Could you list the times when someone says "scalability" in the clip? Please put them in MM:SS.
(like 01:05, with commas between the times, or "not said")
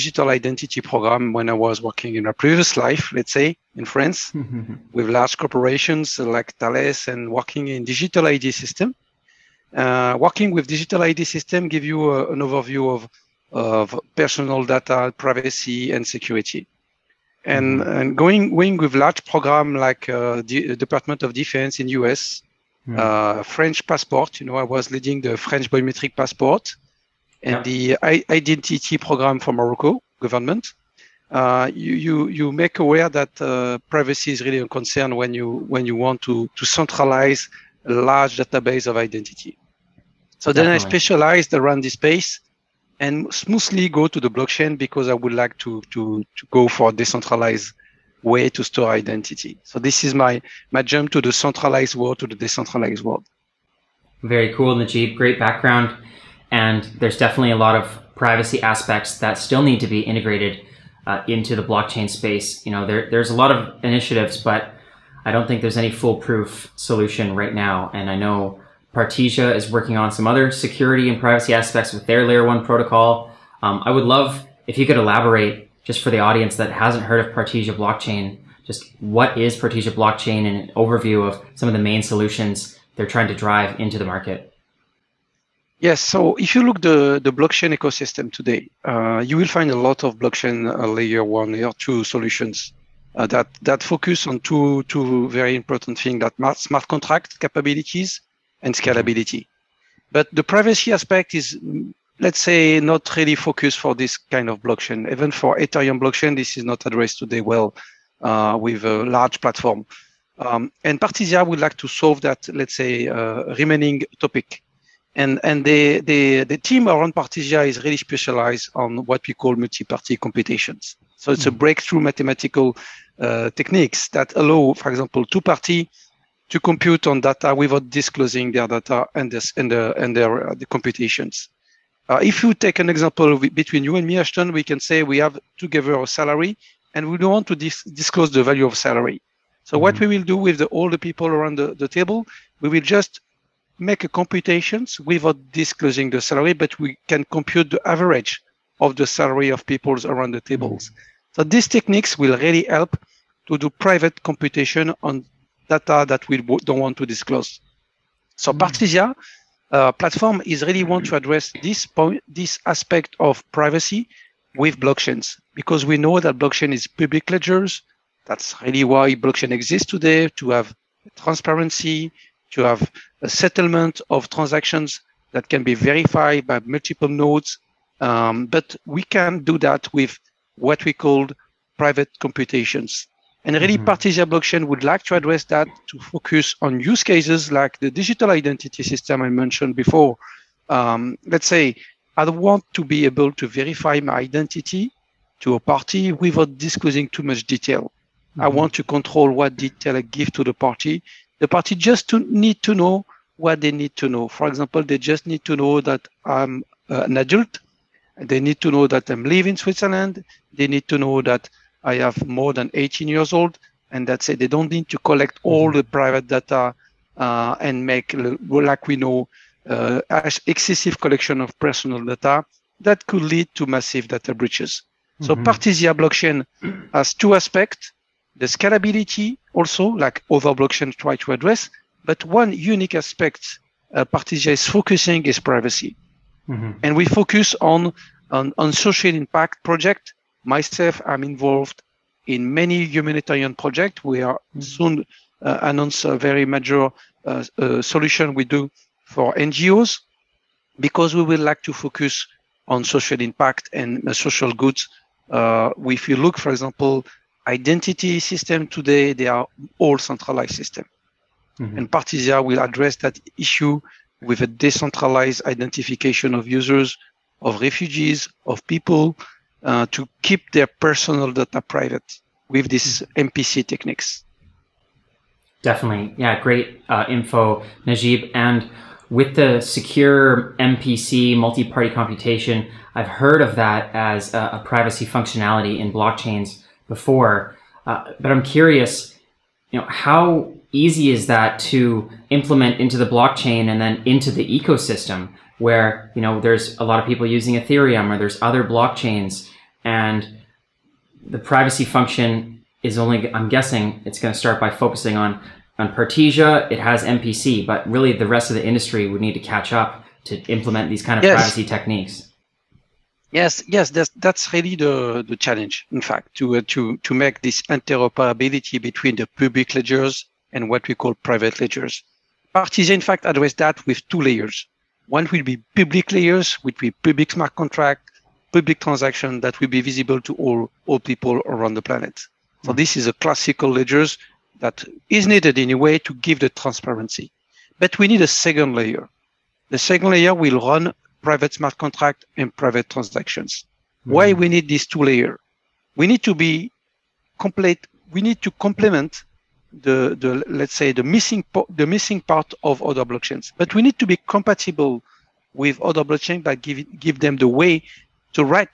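01:38, 03:48.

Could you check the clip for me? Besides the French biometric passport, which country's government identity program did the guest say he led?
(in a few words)
Morocco.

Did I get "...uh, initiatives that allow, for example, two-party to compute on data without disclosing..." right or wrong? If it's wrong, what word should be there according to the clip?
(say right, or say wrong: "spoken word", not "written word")
wrong: "techniques", not "initiatives".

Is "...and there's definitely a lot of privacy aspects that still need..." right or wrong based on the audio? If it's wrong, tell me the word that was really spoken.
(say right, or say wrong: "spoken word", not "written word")
right.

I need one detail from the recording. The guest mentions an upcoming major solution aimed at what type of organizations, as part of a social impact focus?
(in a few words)
NGOs.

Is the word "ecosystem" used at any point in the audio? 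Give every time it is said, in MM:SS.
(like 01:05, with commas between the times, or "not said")
01:27, 04:54.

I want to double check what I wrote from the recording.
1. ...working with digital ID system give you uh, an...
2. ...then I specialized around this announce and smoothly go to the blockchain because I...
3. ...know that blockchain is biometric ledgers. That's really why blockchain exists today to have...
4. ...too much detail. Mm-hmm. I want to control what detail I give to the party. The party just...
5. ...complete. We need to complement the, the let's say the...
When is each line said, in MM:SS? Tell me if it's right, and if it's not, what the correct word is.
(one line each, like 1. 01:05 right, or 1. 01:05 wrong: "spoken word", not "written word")
1. 00:10 right
2. 00:40 wrong: "space", not "announce"
3. 02:46 wrong: "public", not "biometric"
4. 03:17 right
5. 05:47 right.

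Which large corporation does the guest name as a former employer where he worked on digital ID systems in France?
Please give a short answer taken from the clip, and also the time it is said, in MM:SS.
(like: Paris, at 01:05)
Thales, at 00:06.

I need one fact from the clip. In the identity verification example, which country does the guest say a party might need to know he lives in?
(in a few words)
Switzerland.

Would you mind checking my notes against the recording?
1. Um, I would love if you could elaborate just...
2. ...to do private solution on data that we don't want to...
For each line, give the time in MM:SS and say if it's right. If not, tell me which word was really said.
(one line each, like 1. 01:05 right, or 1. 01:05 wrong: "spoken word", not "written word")
1. 01:13 right
2. 02:33 wrong: "computation", not "solution".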